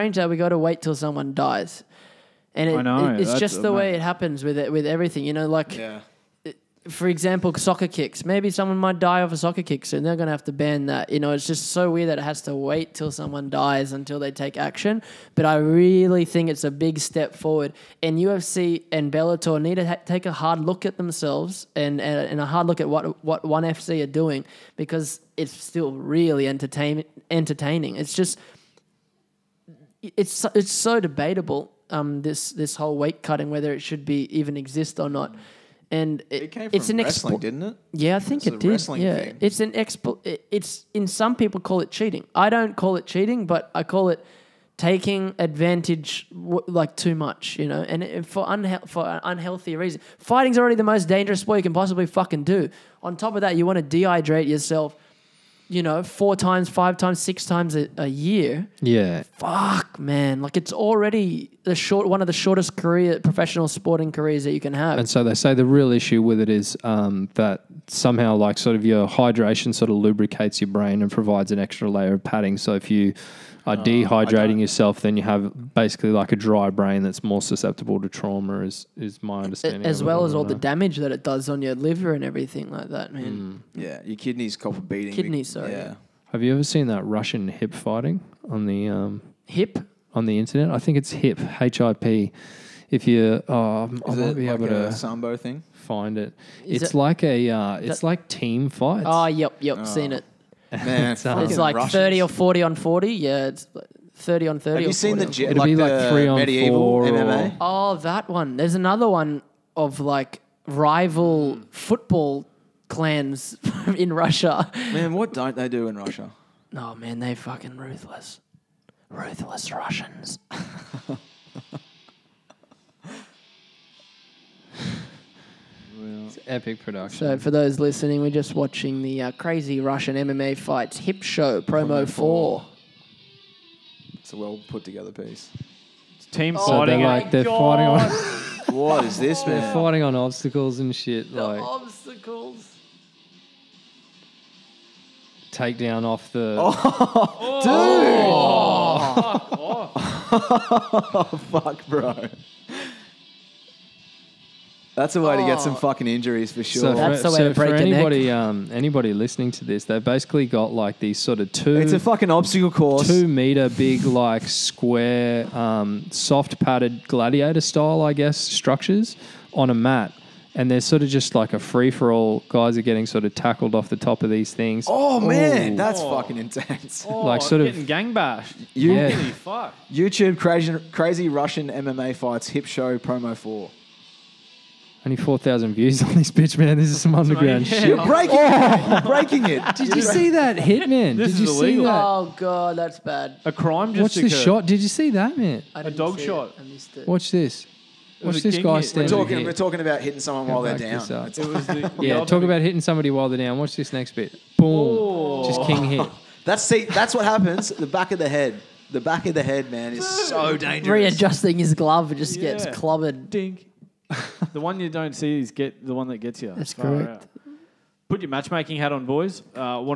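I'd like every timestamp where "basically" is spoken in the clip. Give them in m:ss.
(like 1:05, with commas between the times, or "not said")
1:15, 2:40.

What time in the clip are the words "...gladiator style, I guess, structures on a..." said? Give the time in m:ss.
2:47.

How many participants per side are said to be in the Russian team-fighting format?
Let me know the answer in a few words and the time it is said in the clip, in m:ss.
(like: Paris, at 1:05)
30, at 1:44.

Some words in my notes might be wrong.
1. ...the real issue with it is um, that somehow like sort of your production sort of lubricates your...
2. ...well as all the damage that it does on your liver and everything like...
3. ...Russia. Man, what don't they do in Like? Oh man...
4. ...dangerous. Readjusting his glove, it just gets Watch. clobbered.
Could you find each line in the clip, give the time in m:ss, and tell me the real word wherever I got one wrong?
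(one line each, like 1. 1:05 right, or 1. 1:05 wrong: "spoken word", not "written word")
1. 1:05 wrong: "hydration", not "production"
2. 1:20 right
3. 1:54 wrong: "Russia", not "Like"
4. 3:30 wrong: "Yeah", not "Watch".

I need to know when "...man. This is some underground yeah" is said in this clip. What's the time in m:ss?
3:06.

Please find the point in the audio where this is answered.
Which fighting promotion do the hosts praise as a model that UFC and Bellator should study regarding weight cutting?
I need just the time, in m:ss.
0:23.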